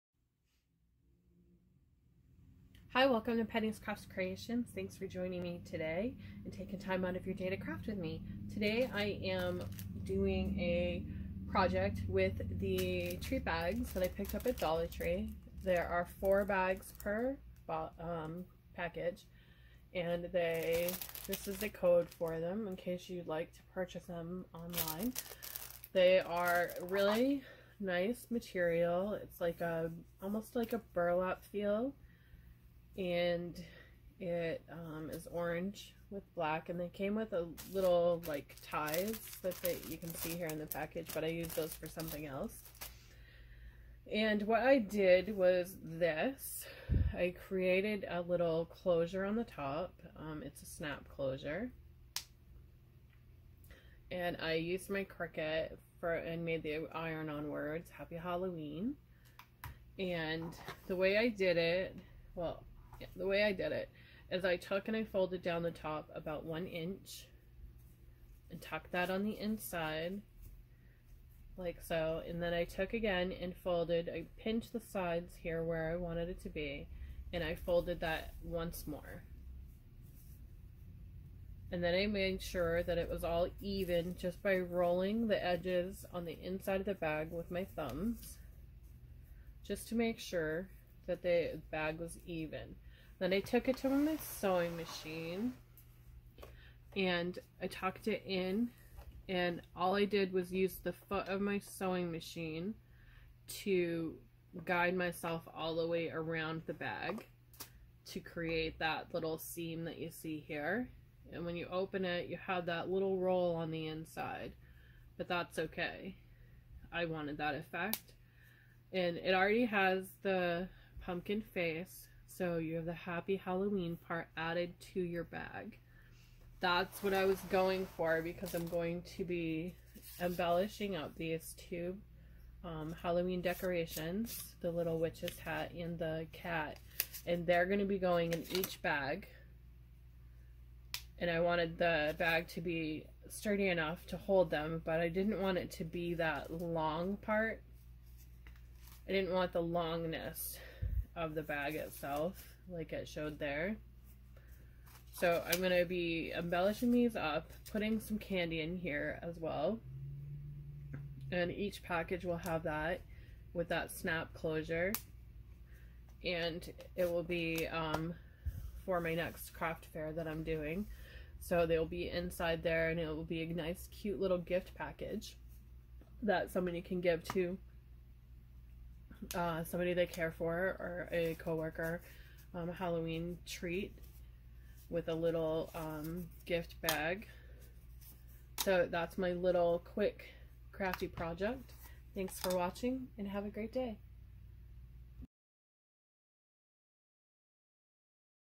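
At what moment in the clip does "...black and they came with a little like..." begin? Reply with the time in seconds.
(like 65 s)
36 s.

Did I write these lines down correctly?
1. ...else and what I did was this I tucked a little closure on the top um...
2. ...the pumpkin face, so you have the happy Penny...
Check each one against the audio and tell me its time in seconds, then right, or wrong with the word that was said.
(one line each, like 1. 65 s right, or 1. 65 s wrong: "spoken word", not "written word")
1. 42 s wrong: "created", not "tucked"
2. 120 s wrong: "Halloween", not "Penny".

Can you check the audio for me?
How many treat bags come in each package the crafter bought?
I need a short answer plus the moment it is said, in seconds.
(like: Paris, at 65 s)
4, at 16 s.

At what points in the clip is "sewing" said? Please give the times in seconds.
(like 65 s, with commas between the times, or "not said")
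94 s, 101 s.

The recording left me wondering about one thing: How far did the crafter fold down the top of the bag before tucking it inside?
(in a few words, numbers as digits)
1 inch.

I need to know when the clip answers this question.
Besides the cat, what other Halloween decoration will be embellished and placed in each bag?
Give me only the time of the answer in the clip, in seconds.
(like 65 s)
134 s.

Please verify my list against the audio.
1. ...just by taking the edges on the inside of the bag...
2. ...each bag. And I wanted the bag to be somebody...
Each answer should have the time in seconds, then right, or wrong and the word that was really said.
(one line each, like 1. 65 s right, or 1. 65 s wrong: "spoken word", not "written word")
1. 84 s wrong: "rolling", not "taking"
2. 138 s wrong: "sturdy", not "somebody".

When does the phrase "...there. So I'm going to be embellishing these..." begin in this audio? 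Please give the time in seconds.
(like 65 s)
153 s.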